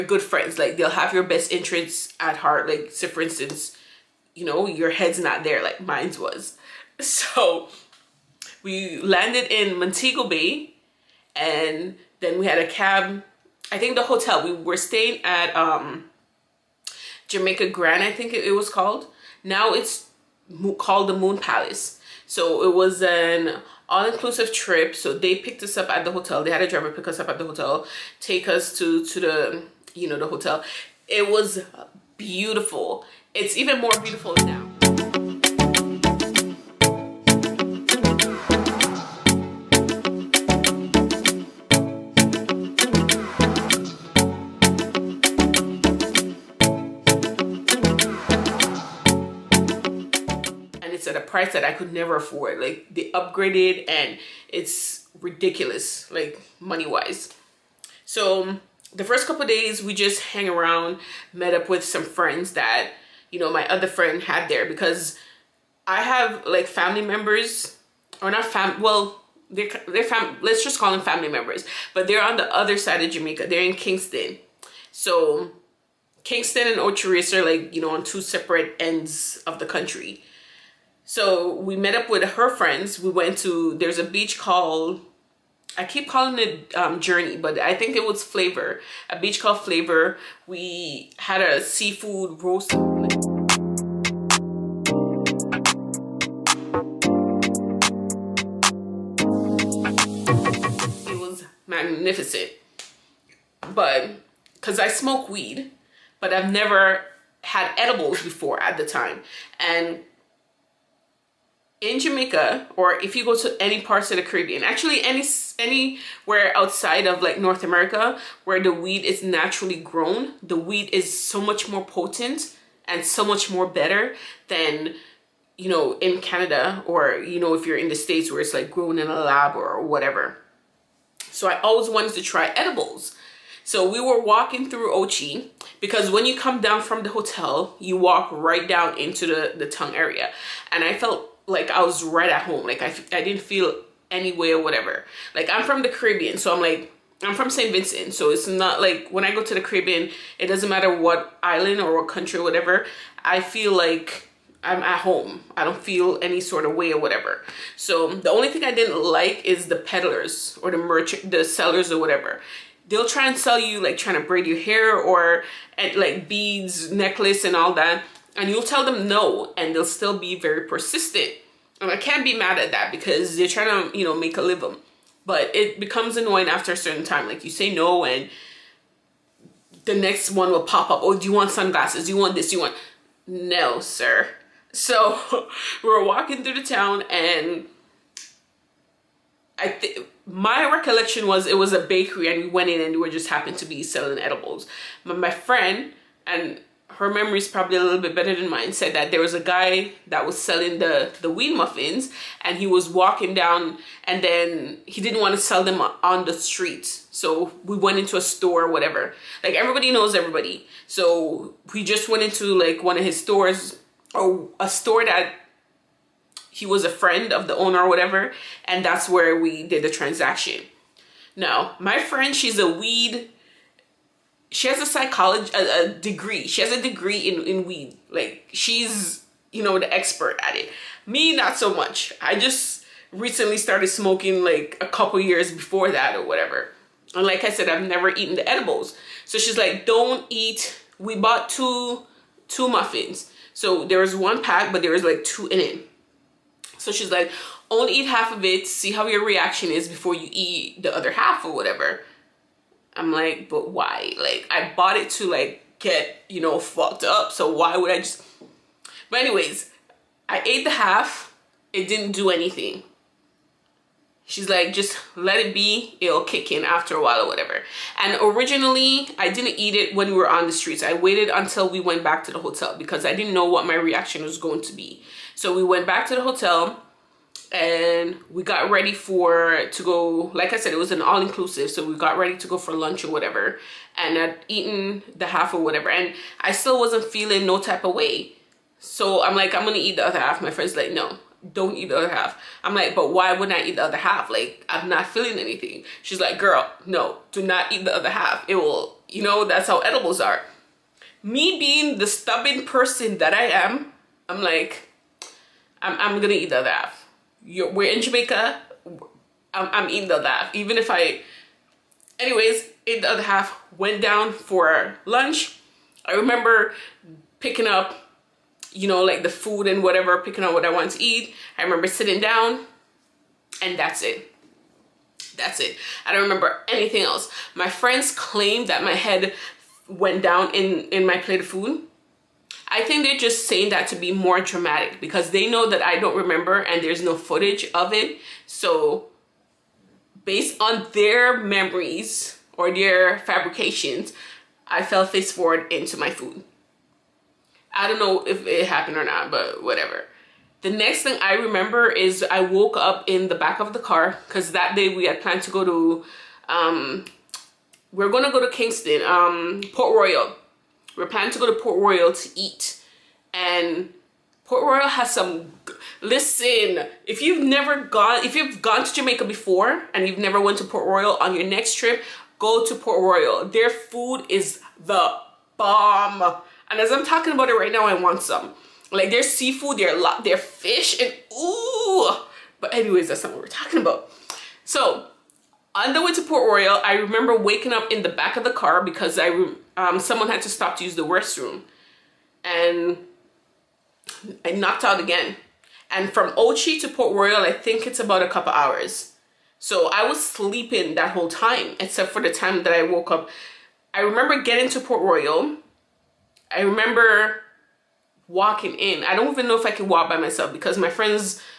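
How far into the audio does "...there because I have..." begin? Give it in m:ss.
1:04.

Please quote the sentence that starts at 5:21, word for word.
I remember sitting down and that's it.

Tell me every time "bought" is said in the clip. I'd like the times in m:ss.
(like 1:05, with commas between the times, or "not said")
4:01, 4:14.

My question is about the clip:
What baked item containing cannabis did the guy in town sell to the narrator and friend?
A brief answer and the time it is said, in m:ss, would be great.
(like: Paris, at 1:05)
weed muffins, at 3:21.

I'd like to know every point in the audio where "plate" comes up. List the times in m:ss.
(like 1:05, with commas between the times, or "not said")
5:31.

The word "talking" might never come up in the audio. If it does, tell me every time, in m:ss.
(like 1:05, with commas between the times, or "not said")
6:17, 6:23.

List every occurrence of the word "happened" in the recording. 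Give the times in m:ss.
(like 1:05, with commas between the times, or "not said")
3:13, 5:48.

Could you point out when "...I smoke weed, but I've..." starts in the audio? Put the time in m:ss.
1:44.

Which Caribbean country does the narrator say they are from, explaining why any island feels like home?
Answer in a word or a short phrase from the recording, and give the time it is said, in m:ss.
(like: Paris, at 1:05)
St. Vincent, at 2:27.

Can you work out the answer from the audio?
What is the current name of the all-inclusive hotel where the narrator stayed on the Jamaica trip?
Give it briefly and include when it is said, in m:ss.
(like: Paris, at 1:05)
Moon Palace, at 0:21.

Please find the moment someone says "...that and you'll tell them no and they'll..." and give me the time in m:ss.
2:47.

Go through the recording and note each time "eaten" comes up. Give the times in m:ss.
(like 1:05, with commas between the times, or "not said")
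3:58, 4:44.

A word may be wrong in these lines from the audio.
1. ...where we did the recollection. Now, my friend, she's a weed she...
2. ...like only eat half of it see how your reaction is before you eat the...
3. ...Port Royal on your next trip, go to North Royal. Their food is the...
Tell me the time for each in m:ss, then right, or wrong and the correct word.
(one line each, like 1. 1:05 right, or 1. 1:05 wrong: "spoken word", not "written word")
1. 3:39 wrong: "transaction", not "recollection"
2. 4:07 right
3. 6:10 wrong: "Port", not "North".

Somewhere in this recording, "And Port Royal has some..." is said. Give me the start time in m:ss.
6:03.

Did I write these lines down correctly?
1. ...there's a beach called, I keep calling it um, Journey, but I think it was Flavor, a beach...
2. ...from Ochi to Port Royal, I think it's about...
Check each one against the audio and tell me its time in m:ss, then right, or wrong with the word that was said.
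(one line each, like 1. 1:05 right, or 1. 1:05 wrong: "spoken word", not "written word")
1. 1:23 right
2. 6:36 right.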